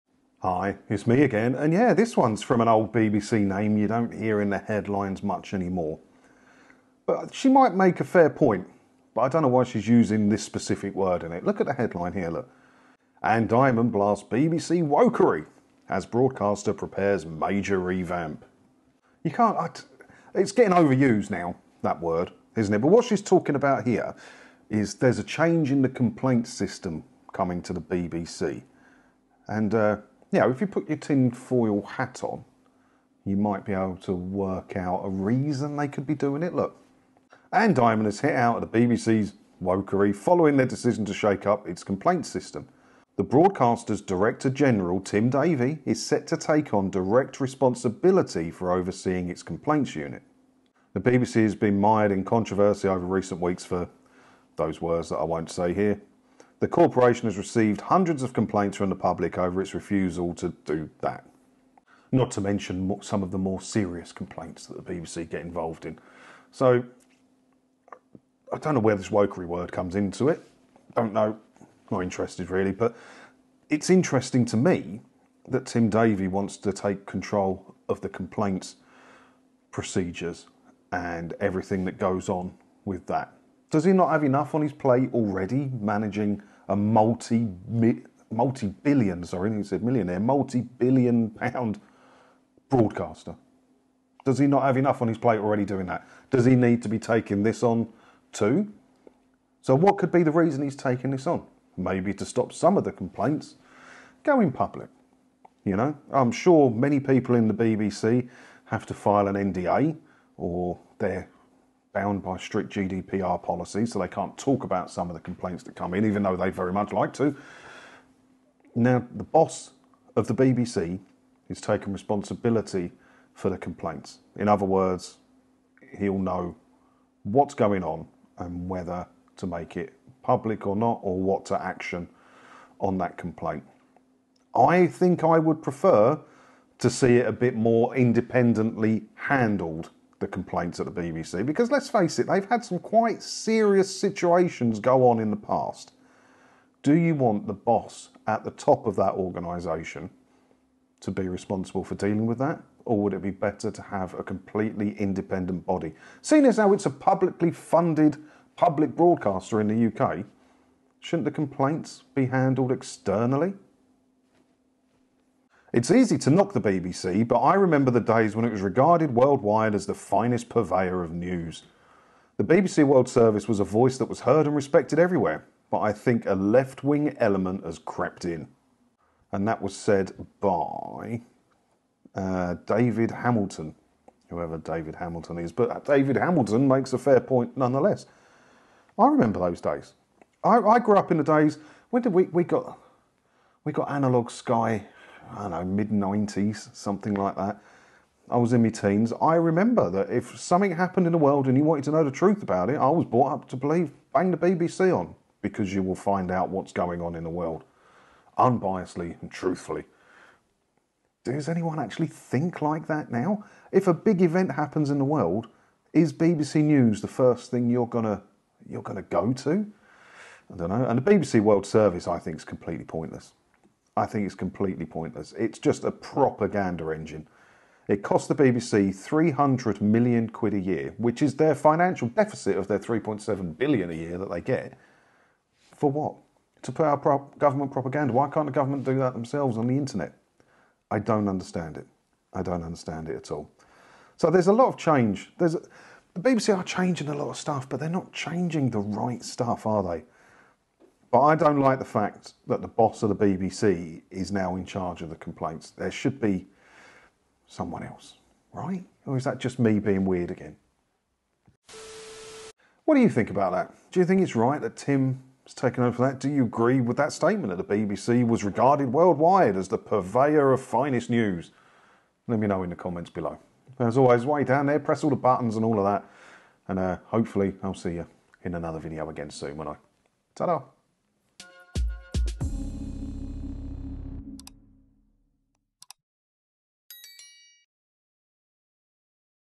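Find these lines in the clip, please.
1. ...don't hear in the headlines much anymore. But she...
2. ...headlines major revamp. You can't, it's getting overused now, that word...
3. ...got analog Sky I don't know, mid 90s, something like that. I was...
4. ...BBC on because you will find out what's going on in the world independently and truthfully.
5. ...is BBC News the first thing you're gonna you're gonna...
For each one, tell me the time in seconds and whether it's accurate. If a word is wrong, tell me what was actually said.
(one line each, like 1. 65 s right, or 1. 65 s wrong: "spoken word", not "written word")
1. 3 s right
2. 16 s wrong: "prepares", not "headlines"
3. 193 s right
4. 204 s wrong: "unbiasedly", not "independently"
5. 215 s right.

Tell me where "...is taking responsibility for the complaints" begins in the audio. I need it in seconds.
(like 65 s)
121 s.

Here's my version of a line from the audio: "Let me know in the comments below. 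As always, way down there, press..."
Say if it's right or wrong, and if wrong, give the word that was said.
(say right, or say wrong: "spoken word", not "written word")
right.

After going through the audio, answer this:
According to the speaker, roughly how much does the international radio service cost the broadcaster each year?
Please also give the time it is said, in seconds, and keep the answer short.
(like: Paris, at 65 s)
300 million, at 228 s.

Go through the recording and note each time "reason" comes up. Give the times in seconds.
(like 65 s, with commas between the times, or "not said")
35 s, 100 s.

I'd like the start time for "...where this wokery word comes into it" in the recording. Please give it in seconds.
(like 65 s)
68 s.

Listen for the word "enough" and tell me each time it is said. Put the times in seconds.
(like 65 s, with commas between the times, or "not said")
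84 s, 94 s.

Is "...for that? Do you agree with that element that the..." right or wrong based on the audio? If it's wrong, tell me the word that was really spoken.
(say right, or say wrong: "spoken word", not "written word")
wrong: "statement", not "element".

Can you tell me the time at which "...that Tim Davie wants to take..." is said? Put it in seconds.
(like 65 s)
75 s.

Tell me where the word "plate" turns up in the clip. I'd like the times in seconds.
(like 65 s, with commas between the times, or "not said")
84 s, 95 s.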